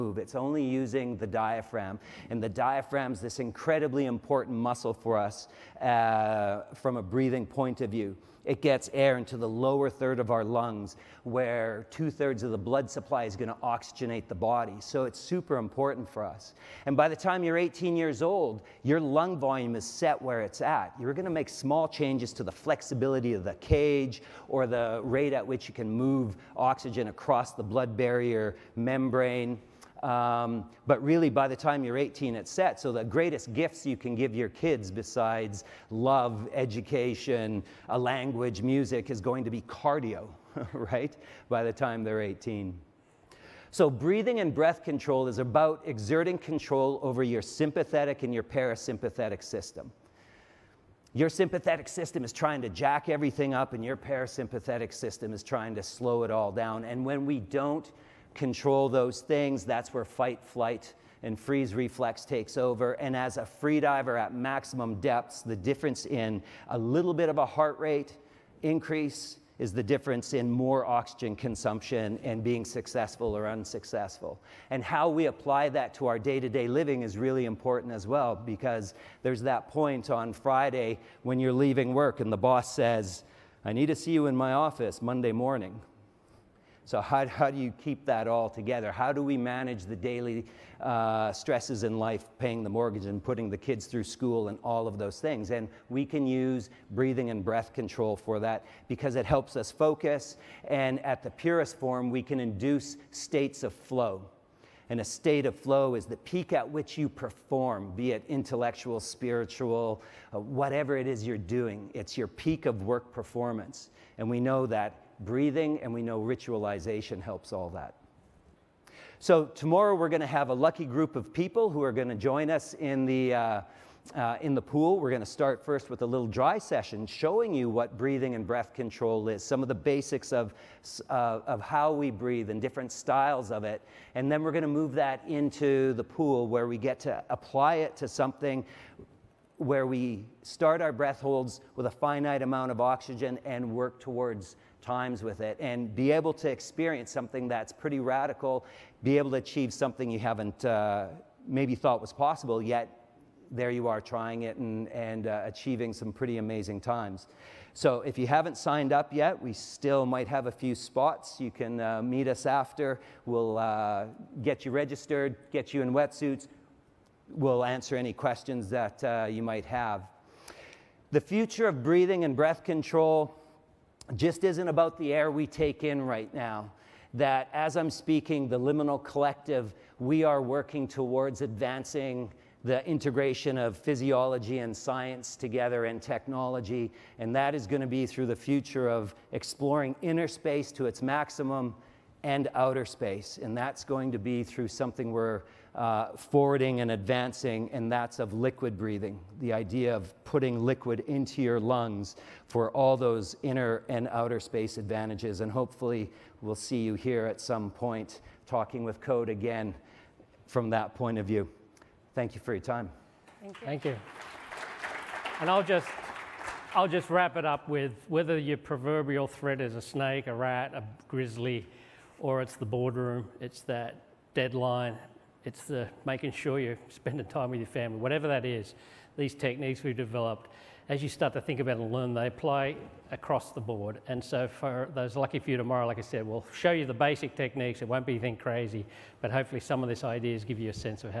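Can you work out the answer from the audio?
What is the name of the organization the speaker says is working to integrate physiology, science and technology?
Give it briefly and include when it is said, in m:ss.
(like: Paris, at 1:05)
The Liminal Collective, at 2:58.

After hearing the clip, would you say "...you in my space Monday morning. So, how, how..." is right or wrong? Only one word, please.
wrong.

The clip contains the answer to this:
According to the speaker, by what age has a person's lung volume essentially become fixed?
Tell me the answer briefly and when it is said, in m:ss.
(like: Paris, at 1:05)
18, at 0:17.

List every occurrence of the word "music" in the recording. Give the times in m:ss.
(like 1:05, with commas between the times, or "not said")
0:38.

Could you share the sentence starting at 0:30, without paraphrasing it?
Um, but really, by the time you're 18, it's set.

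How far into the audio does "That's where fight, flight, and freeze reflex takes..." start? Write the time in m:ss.
0:59.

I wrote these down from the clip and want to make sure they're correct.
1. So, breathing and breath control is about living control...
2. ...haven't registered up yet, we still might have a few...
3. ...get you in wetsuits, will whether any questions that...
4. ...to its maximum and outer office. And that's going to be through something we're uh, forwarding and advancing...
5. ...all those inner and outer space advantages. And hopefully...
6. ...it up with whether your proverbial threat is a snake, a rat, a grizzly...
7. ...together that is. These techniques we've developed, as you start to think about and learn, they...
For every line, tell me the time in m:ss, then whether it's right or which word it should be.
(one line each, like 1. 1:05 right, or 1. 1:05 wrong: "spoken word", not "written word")
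1. 0:43 wrong: "exerting", not "living"
2. 2:38 wrong: "signed", not "registered"
3. 2:45 wrong: "answer", not "whether"
4. 3:10 wrong: "space", not "office"
5. 3:22 right
6. 3:37 right
7. 3:47 wrong: "whatever", not "together".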